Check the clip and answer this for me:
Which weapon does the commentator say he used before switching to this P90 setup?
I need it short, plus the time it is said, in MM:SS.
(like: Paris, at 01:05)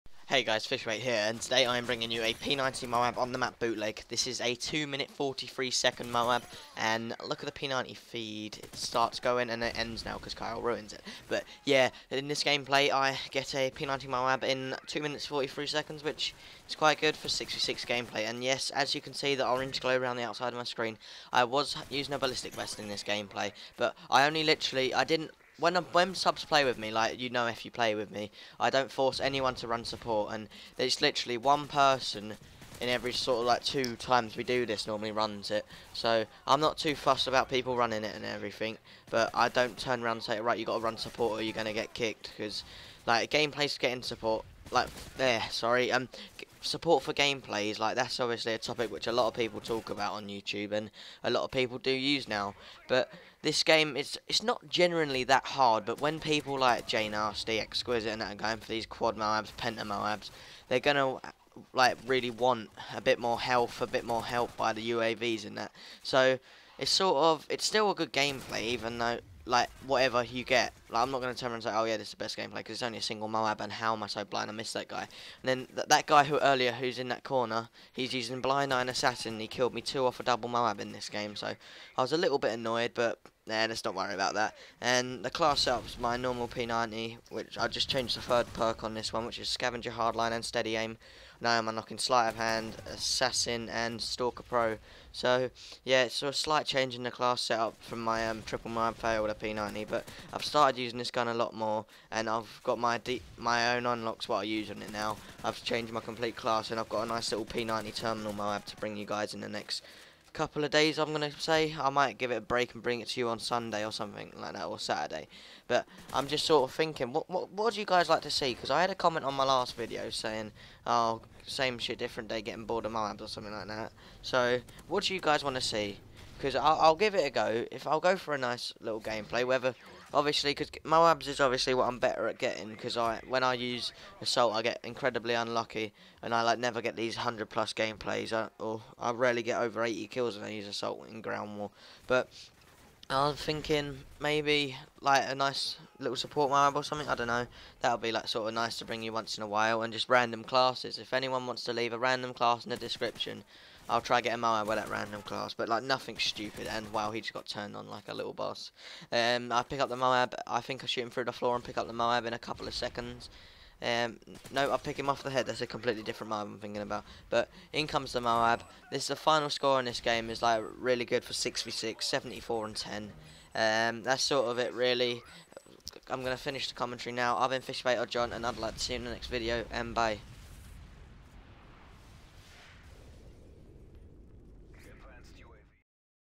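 Triple Nine Fail, at 01:38.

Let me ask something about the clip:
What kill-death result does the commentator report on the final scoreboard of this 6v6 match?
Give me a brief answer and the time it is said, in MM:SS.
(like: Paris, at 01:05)
74 and 10, at 02:52.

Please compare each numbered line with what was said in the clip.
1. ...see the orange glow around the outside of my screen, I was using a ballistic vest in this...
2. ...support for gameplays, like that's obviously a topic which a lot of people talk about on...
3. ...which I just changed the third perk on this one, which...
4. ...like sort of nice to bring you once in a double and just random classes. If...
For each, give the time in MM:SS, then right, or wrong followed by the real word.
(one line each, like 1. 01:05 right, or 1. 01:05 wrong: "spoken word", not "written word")
1. 00:19 right
2. 00:46 right
3. 01:27 right
4. 02:28 wrong: "while", not "double".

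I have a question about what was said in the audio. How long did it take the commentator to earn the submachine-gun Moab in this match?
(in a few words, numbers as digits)
2 minutes 43 seconds.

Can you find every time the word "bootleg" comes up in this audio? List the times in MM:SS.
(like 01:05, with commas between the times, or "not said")
00:03.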